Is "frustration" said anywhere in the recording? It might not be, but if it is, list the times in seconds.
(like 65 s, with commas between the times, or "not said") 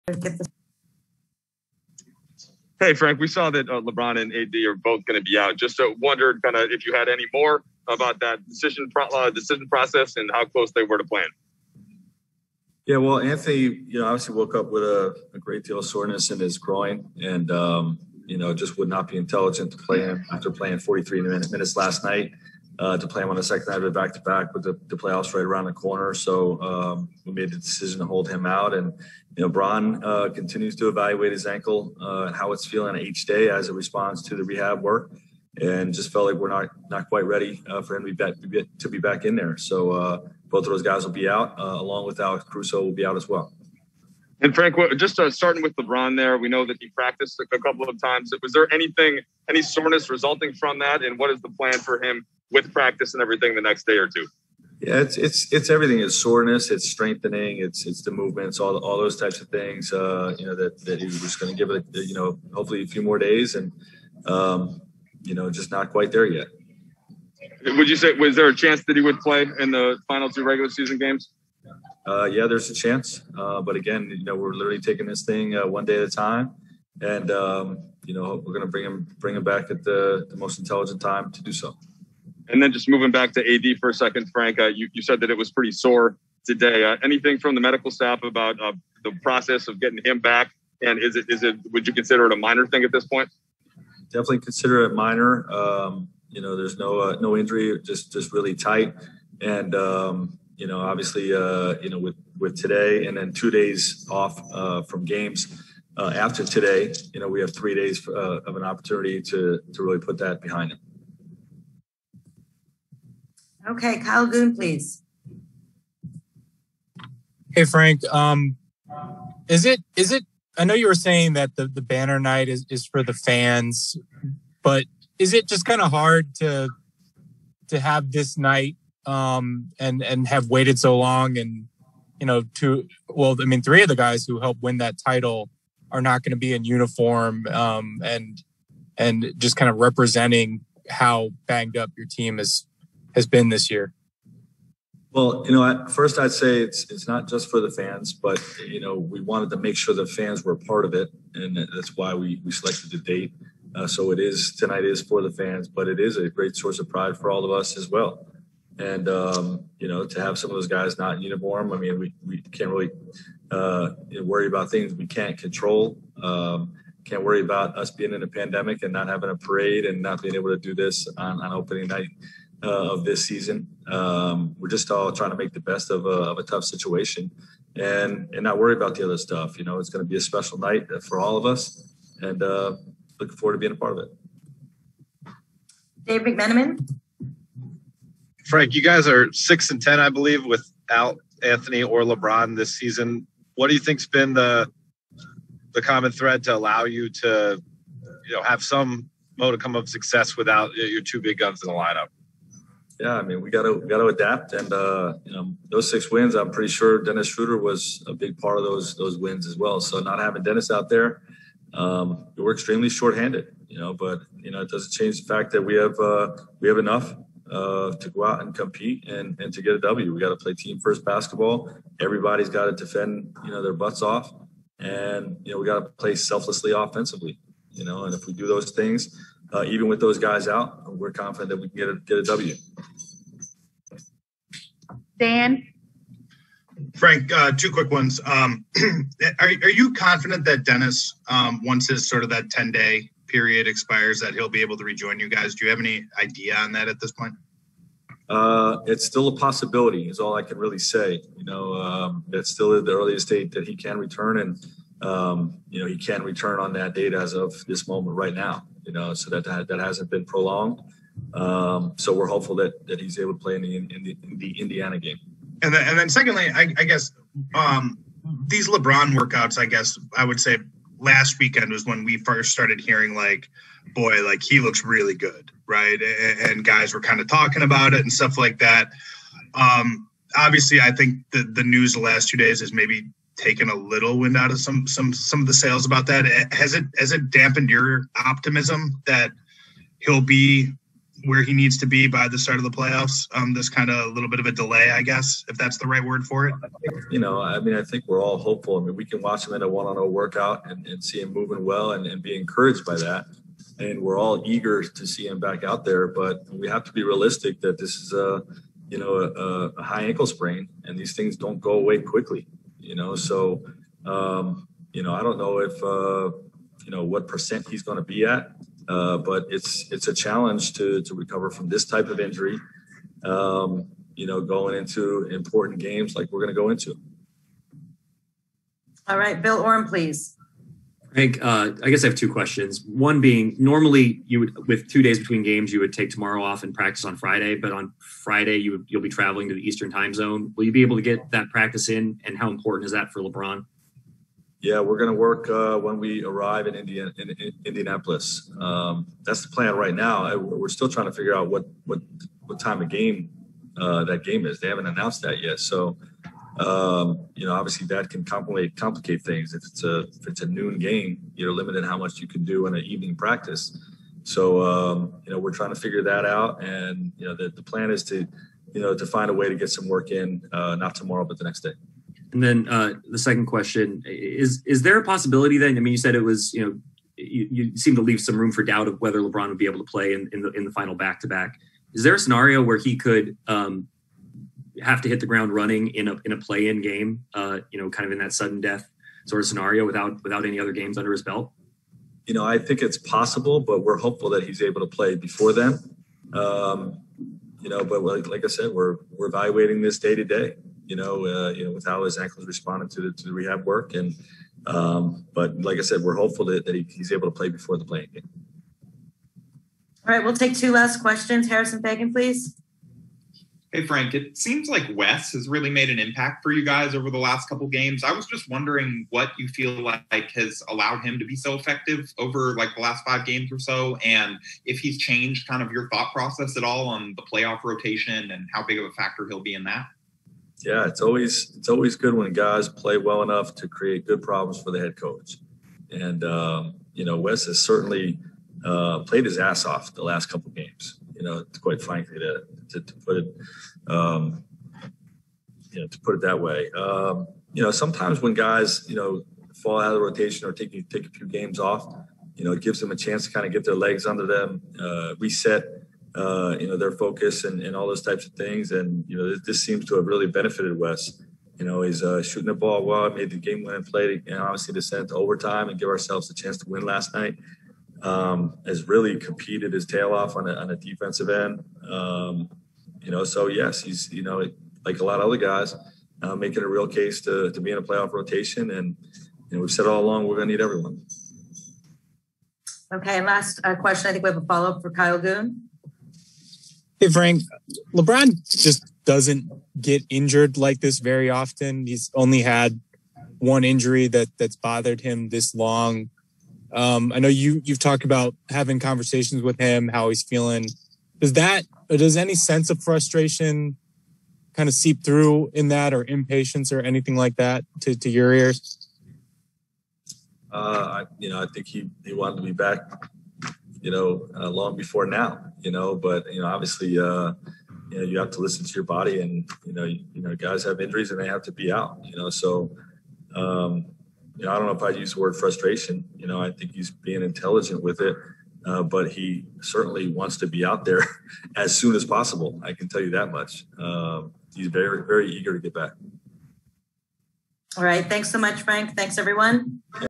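502 s, 525 s.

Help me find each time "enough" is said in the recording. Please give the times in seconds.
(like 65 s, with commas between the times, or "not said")
216 s, 433 s.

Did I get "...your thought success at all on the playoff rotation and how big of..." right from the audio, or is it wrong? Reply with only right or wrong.
wrong.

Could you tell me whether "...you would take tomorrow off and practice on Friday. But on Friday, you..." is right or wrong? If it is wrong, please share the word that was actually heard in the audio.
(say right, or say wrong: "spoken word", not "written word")
right.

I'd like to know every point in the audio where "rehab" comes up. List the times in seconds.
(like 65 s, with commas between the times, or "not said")
34 s, 403 s.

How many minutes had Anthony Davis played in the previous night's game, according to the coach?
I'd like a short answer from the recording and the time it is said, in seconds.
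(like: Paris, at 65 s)
43, at 20 s.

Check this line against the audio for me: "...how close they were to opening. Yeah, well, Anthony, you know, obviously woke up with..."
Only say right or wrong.
wrong.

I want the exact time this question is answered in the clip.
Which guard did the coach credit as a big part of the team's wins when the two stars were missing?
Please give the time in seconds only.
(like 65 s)
207 s.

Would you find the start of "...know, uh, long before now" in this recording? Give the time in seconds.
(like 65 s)
513 s.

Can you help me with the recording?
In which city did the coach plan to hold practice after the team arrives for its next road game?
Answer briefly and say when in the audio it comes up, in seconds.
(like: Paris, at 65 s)
Indianapolis, at 347 s.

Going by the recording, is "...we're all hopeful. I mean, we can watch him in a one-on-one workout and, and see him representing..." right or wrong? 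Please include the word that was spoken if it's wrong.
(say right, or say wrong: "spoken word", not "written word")
wrong: "moving", not "representing".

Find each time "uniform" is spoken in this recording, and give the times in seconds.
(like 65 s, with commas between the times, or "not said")
136 s, 161 s.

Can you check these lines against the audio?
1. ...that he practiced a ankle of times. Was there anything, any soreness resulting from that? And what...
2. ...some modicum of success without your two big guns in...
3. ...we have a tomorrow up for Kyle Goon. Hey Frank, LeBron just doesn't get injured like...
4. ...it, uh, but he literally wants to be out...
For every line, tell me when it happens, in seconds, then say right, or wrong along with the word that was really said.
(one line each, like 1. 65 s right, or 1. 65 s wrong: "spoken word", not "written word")
1. 46 s wrong: "couple", not "ankle"
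2. 198 s right
3. 484 s wrong: "follow", not "tomorrow"
4. 528 s wrong: "certainly", not "literally".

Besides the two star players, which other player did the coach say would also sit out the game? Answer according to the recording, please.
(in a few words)
Alex Caruso.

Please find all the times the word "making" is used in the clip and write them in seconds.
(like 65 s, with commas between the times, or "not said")
476 s.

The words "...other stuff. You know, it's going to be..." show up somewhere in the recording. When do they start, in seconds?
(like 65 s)
179 s.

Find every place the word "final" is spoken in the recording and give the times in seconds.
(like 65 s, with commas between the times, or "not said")
70 s, 380 s.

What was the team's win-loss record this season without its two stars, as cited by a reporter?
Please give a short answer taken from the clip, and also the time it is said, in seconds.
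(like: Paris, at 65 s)
6 and 10, at 189 s.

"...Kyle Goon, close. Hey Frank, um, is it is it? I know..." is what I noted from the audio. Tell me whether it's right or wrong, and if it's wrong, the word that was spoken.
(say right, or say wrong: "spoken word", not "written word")
wrong: "please", not "close".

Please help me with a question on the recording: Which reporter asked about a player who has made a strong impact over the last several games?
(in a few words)
Harrison Faigen.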